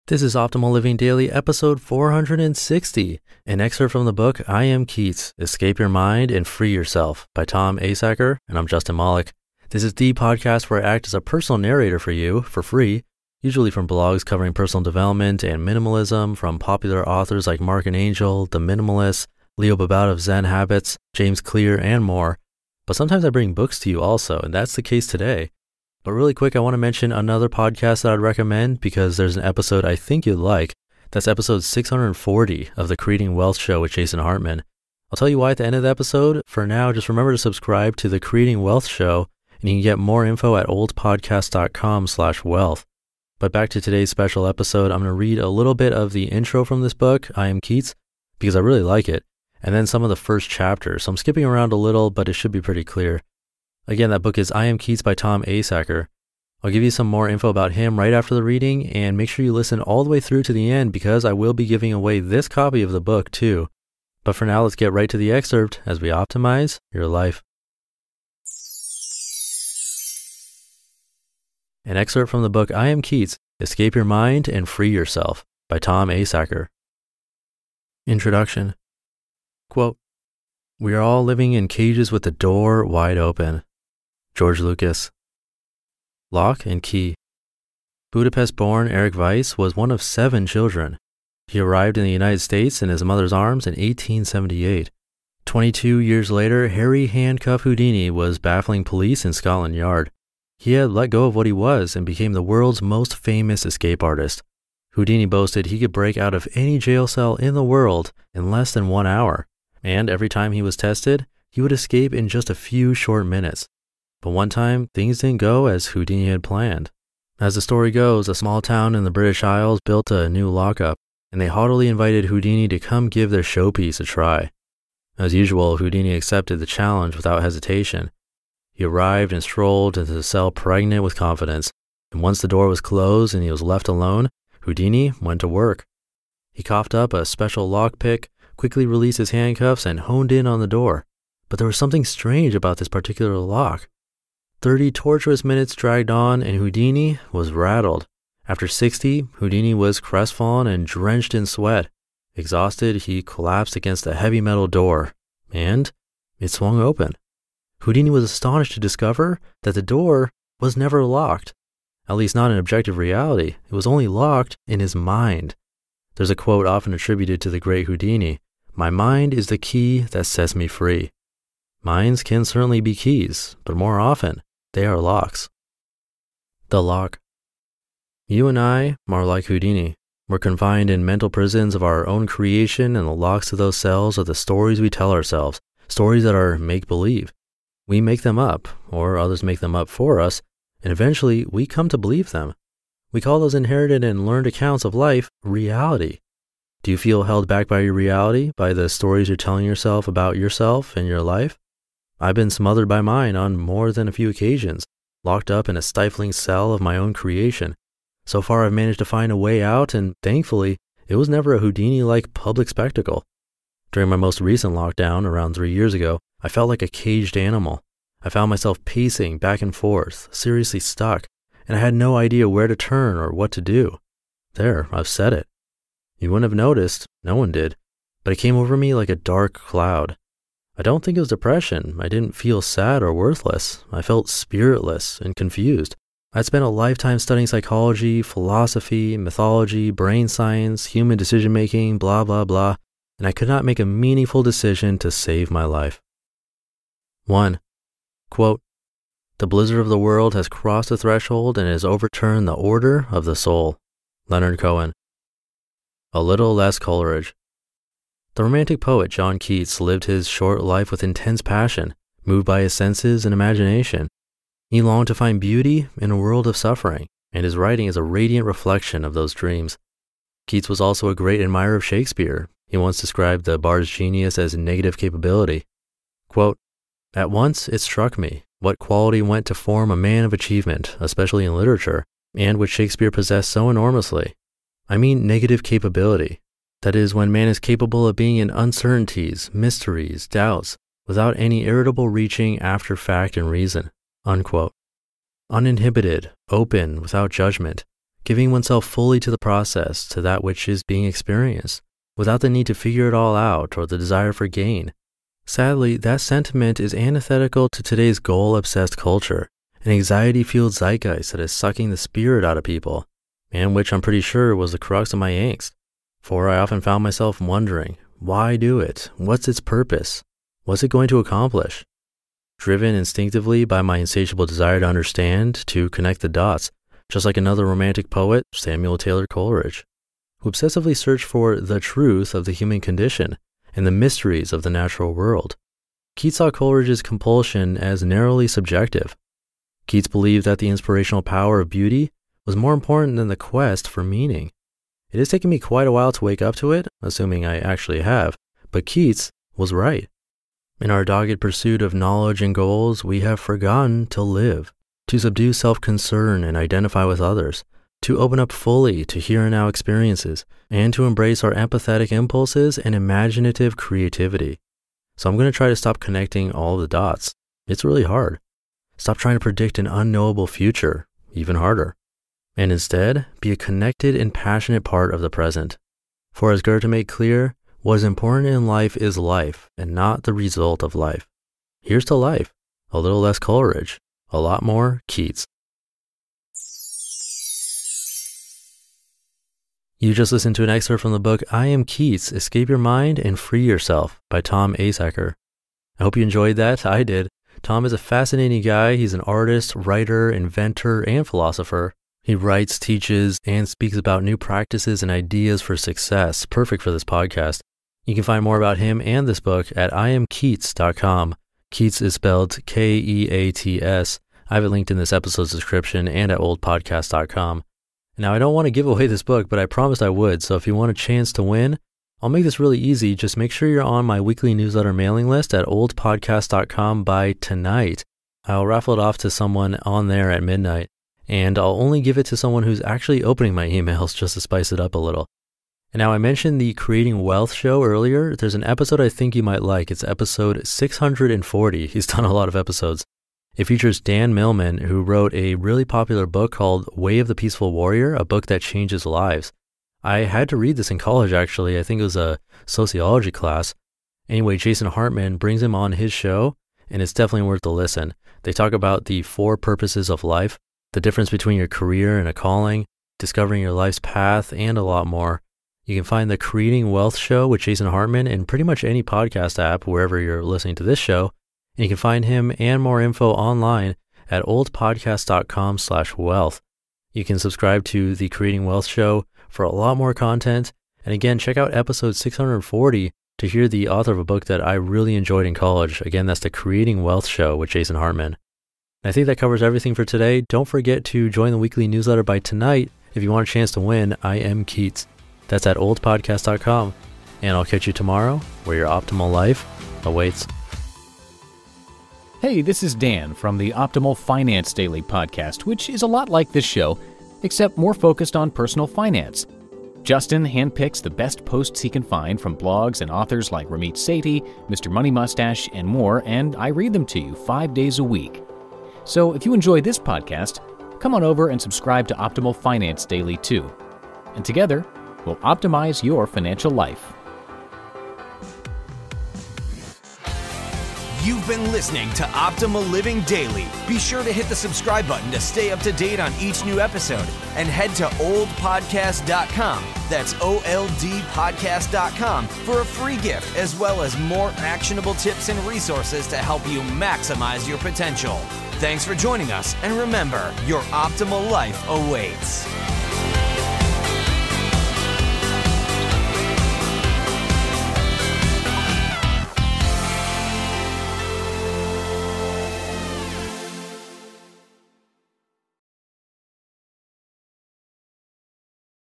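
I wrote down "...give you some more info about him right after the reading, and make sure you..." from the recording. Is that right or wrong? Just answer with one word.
right.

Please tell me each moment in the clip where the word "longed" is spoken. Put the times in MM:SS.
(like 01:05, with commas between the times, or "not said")
04:24.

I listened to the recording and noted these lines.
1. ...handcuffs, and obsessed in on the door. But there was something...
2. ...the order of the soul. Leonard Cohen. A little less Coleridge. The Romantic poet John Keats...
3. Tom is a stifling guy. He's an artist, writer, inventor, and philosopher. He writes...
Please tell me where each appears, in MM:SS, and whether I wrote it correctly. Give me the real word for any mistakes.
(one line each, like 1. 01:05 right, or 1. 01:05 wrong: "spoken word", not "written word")
1. 02:19 wrong: "honed", not "obsessed"
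2. 04:12 right
3. 06:37 wrong: "fascinating", not "stifling".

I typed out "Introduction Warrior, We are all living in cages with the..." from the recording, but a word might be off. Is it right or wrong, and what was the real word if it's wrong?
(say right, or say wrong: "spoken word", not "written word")
wrong: "Quote", not "Warrior".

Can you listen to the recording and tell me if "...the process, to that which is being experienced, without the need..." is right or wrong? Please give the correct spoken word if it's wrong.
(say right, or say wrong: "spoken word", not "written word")
right.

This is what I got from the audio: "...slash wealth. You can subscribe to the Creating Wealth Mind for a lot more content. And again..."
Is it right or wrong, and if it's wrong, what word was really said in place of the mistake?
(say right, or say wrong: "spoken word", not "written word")
wrong: "Show", not "Mind".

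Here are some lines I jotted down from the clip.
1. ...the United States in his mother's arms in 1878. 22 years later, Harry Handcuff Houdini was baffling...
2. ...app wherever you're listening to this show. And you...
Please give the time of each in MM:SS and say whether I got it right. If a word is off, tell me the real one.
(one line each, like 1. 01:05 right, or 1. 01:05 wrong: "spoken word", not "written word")
1. 01:32 right
2. 07:49 right.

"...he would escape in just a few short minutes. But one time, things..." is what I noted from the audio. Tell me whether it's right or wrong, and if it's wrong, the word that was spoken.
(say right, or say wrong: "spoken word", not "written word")
right.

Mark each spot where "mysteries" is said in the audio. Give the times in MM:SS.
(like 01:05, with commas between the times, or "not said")
04:49, 05:33.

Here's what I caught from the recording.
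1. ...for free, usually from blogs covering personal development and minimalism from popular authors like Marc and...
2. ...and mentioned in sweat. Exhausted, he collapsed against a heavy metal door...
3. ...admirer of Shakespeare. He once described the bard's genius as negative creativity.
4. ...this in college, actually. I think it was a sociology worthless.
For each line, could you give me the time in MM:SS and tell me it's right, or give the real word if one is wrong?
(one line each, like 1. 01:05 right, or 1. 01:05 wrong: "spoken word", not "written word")
1. 00:12 right
2. 02:30 wrong: "drenched", not "mentioned"
3. 04:31 wrong: "capability", not "creativity"
4. 07:30 wrong: "class", not "worthless".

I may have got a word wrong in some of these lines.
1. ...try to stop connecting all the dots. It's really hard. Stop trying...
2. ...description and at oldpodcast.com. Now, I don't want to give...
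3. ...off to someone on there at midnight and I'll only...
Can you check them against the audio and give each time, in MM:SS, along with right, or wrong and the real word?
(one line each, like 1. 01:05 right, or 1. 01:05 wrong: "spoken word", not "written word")
1. 06:05 right
2. 06:55 right
3. 07:08 right.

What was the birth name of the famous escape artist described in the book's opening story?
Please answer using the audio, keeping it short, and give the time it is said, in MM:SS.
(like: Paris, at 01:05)
Eric Weiss, at 01:28.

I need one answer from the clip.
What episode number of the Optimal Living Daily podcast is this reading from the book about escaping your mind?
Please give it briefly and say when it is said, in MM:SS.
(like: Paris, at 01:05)
460, at 00:01.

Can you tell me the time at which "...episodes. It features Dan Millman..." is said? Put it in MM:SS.
07:22.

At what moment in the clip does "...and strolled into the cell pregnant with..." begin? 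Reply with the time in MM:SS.
02:09.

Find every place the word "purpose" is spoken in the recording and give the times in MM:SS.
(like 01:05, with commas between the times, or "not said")
05:19, 07:39.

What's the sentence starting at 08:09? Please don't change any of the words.
I think that covers everything for today.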